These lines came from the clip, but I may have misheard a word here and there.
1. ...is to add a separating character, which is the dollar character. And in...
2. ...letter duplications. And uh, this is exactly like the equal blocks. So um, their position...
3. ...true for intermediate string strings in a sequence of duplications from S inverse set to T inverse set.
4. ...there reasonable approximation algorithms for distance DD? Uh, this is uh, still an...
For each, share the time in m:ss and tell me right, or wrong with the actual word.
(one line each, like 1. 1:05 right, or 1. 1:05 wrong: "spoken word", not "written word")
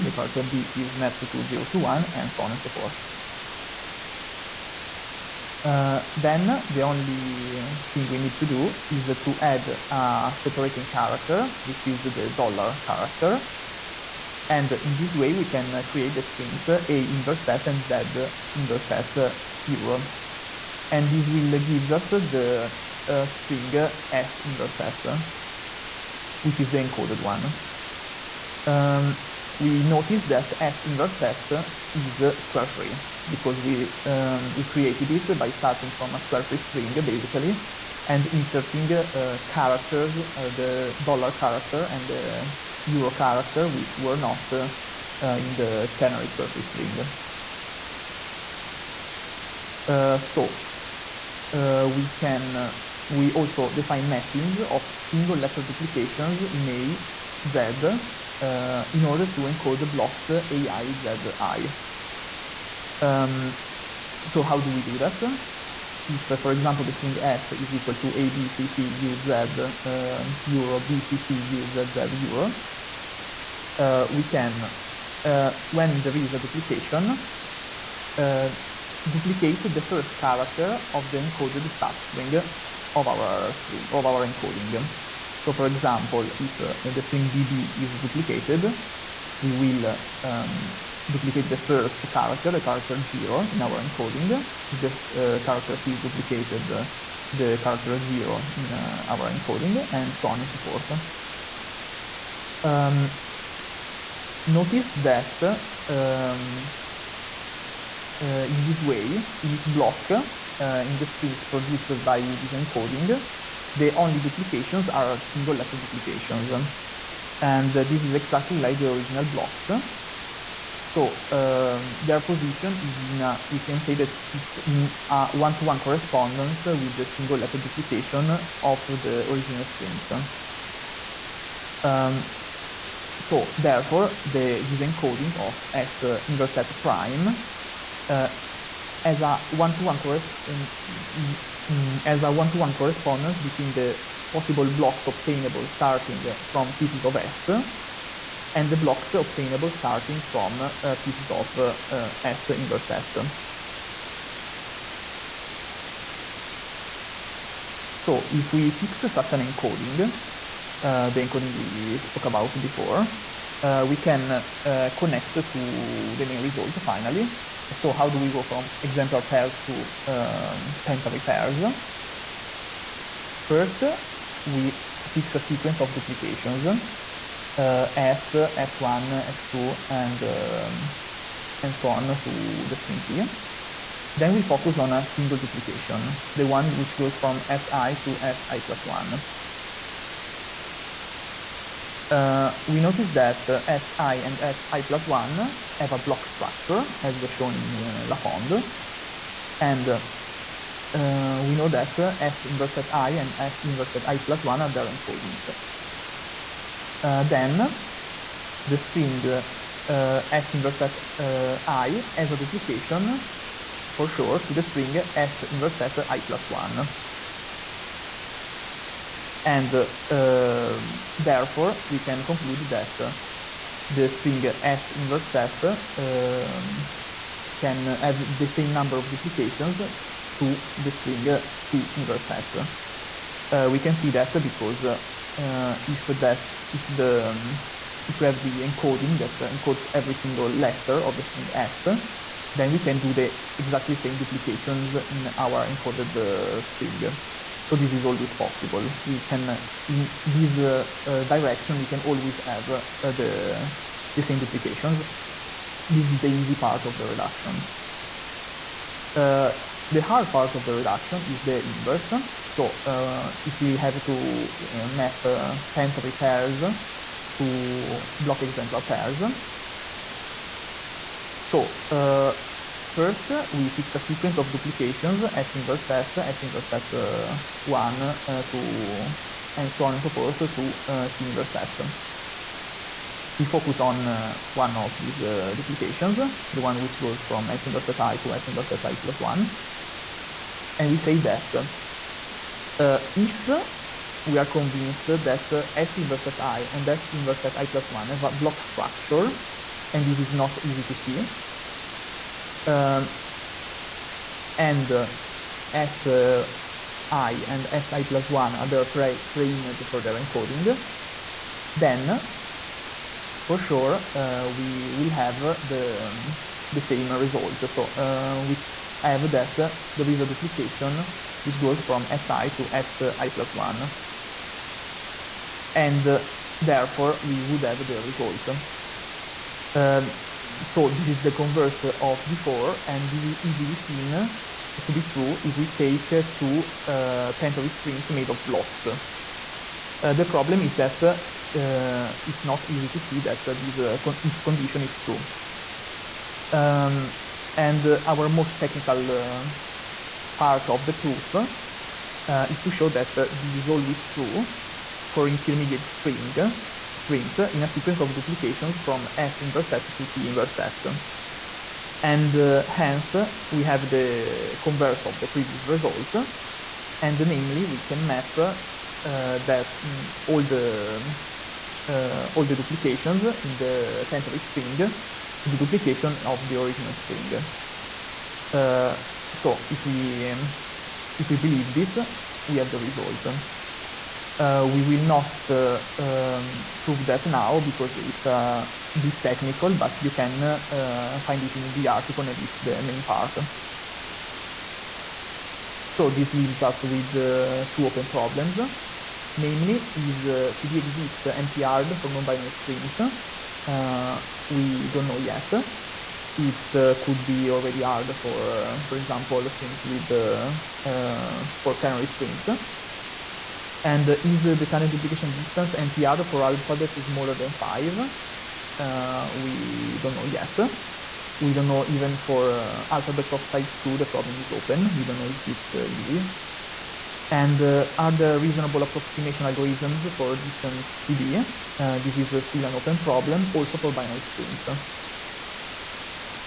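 1. 0:08 right
2. 1:55 wrong: "original", not "equal"
3. 5:54 right
4. 7:08 right.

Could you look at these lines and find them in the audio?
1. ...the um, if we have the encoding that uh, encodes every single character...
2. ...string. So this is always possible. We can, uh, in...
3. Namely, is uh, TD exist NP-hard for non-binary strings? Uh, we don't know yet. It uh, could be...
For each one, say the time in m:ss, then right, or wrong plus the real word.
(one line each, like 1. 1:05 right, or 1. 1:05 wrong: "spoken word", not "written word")
1. 3:56 wrong: "letter", not "character"
2. 4:06 right
3. 6:39 right.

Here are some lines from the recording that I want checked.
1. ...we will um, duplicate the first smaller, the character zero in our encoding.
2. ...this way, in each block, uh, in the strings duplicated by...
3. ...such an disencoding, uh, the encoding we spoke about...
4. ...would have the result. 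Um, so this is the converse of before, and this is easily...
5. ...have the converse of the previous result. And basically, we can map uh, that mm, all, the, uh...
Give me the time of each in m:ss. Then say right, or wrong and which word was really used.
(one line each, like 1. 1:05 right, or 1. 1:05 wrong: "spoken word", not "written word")
1. 1:29 wrong: "character", not "smaller"
2. 1:48 wrong: "produced", not "duplicated"
3. 2:39 wrong: "encoding", not "disencoding"
4. 5:27 right
5. 6:03 wrong: "namely", not "basically".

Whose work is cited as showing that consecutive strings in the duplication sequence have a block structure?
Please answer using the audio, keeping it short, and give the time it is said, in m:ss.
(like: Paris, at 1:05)
Lafond, at 3:18.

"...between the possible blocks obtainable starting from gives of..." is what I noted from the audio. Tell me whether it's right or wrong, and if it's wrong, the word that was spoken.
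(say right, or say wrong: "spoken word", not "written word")
wrong: "pieces", not "gives".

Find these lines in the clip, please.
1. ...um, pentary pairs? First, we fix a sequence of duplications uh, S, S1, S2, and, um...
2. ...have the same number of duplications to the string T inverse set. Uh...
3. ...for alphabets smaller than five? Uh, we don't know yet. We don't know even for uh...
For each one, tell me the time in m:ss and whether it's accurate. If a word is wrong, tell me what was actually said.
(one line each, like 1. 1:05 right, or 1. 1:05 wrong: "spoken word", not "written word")
1. 2:50 right
2. 3:47 right
3. 6:56 right.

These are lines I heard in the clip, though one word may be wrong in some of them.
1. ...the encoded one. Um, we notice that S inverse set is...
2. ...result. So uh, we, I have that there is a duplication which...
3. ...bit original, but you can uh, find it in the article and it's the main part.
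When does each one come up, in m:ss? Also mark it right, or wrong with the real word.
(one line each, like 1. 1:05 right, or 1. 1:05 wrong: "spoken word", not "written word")
1. 0:26 right
2. 5:17 right
3. 6:28 wrong: "technical", not "original".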